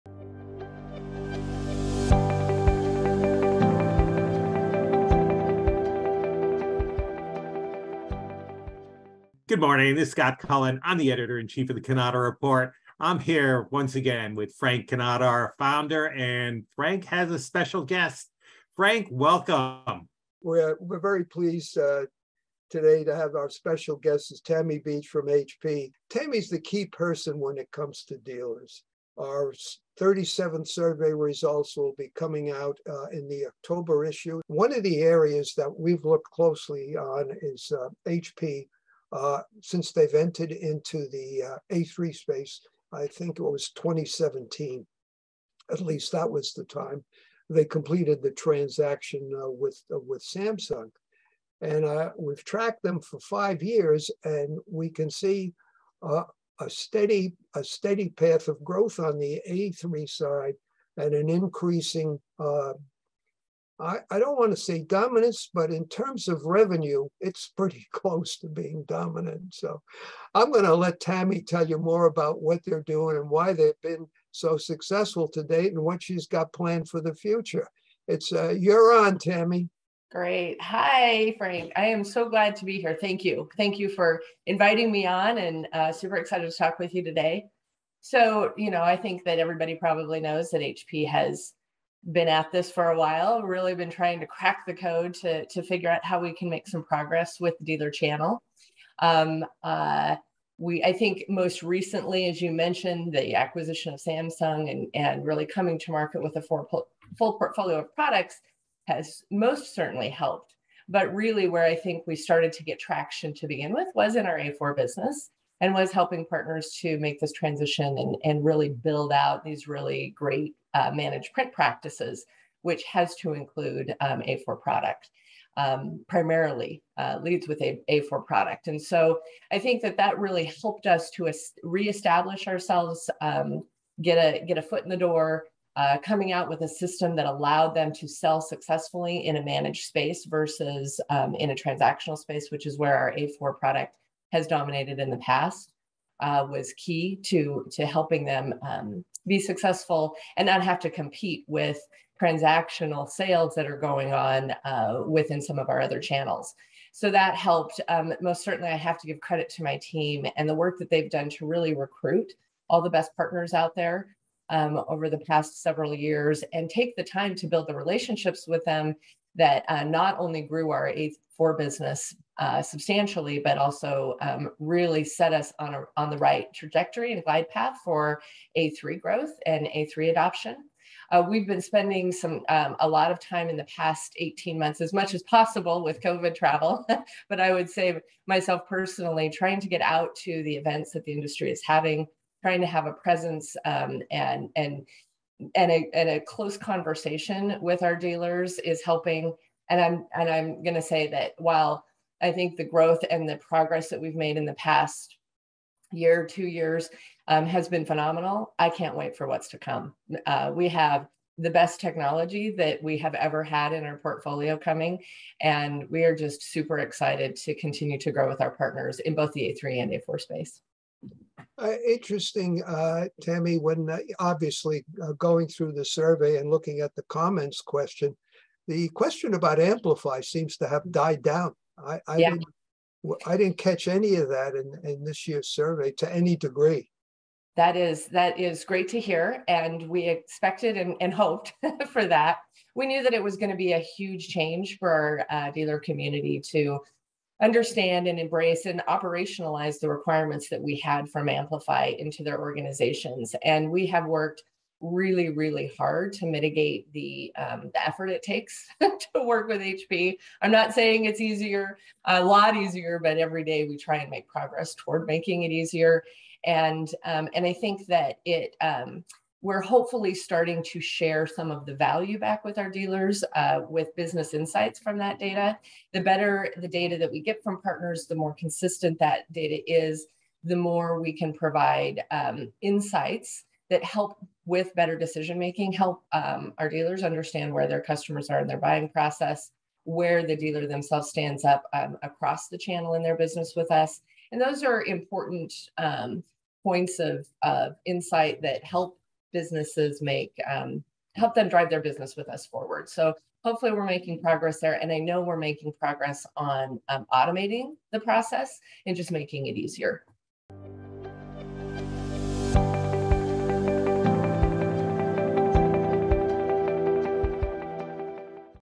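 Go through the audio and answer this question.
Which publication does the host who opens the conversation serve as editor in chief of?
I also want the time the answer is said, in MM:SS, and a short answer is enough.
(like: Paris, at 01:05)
Cannata Report, at 00:11.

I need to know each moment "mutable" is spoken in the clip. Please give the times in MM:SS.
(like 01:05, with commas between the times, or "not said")
not said.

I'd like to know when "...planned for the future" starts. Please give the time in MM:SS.
01:16.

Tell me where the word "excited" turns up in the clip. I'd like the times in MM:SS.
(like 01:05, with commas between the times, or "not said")
01:26, 03:36.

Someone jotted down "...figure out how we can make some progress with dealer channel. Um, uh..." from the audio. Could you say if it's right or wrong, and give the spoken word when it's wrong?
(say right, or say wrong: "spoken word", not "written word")
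right.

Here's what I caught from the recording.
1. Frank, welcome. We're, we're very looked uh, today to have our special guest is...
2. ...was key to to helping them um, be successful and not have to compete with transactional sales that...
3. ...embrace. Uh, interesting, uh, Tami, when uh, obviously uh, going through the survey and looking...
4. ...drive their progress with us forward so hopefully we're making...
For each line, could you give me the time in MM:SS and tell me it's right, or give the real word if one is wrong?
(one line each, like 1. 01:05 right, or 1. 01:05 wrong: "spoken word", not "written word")
1. 00:18 wrong: "pleased", not "looked"
2. 02:26 right
3. 03:40 wrong: "space", not "embrace"
4. 05:01 wrong: "business", not "progress".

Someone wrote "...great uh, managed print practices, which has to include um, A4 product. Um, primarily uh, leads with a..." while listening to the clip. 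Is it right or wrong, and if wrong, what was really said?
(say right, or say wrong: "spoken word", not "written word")
right.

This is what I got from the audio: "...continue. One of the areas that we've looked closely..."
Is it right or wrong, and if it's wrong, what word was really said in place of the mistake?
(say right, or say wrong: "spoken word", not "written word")
wrong: "issue", not "continue".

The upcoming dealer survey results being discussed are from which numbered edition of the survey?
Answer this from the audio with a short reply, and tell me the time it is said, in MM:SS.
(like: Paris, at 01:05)
37th, at 00:29.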